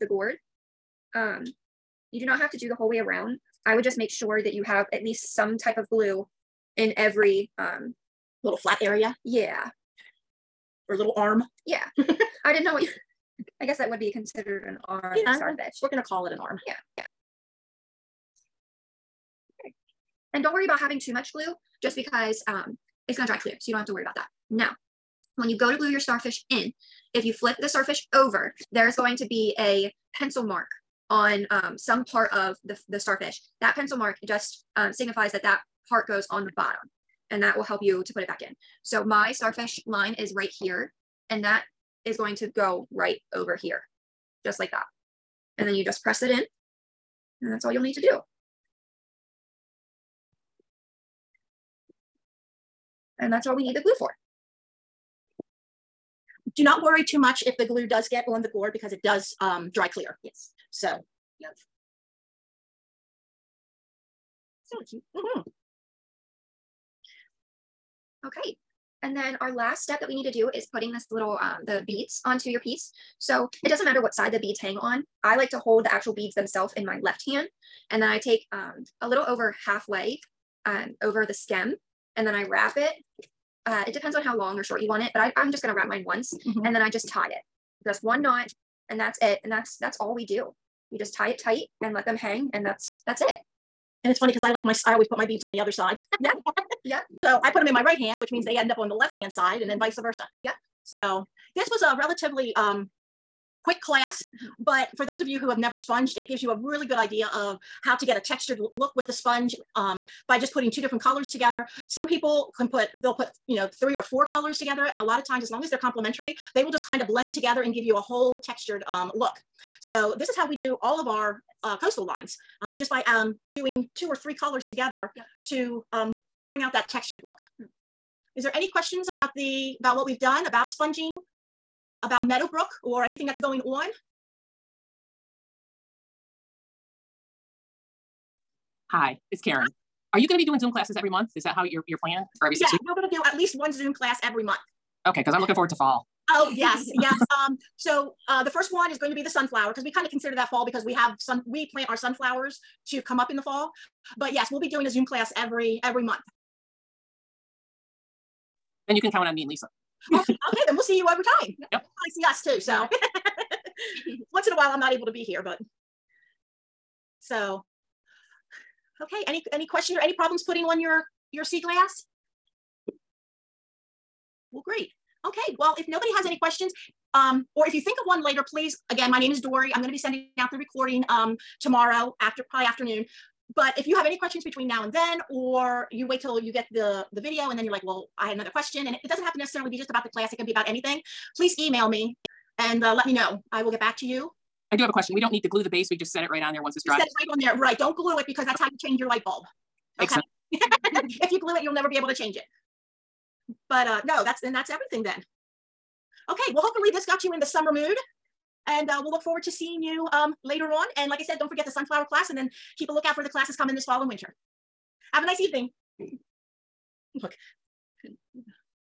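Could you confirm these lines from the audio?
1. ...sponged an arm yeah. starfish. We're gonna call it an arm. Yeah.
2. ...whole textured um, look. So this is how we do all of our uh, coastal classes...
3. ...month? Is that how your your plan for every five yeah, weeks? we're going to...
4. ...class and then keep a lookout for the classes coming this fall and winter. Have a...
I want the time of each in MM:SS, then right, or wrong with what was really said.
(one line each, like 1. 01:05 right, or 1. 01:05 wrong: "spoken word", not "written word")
1. 00:14 wrong: "considered", not "sponged"
2. 01:57 wrong: "lines", not "classes"
3. 02:21 wrong: "six", not "five"
4. 03:32 right.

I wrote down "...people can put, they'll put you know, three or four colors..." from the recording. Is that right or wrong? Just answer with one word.
right.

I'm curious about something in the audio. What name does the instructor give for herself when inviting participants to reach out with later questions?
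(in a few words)
Dori.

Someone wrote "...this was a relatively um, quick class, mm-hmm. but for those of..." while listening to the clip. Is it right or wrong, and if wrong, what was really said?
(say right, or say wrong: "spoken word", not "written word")
right.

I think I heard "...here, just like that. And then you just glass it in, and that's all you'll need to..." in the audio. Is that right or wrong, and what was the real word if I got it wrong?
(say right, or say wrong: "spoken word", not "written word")
wrong: "press", not "glass".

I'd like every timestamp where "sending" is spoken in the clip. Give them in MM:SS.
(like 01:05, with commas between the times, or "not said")
02:59.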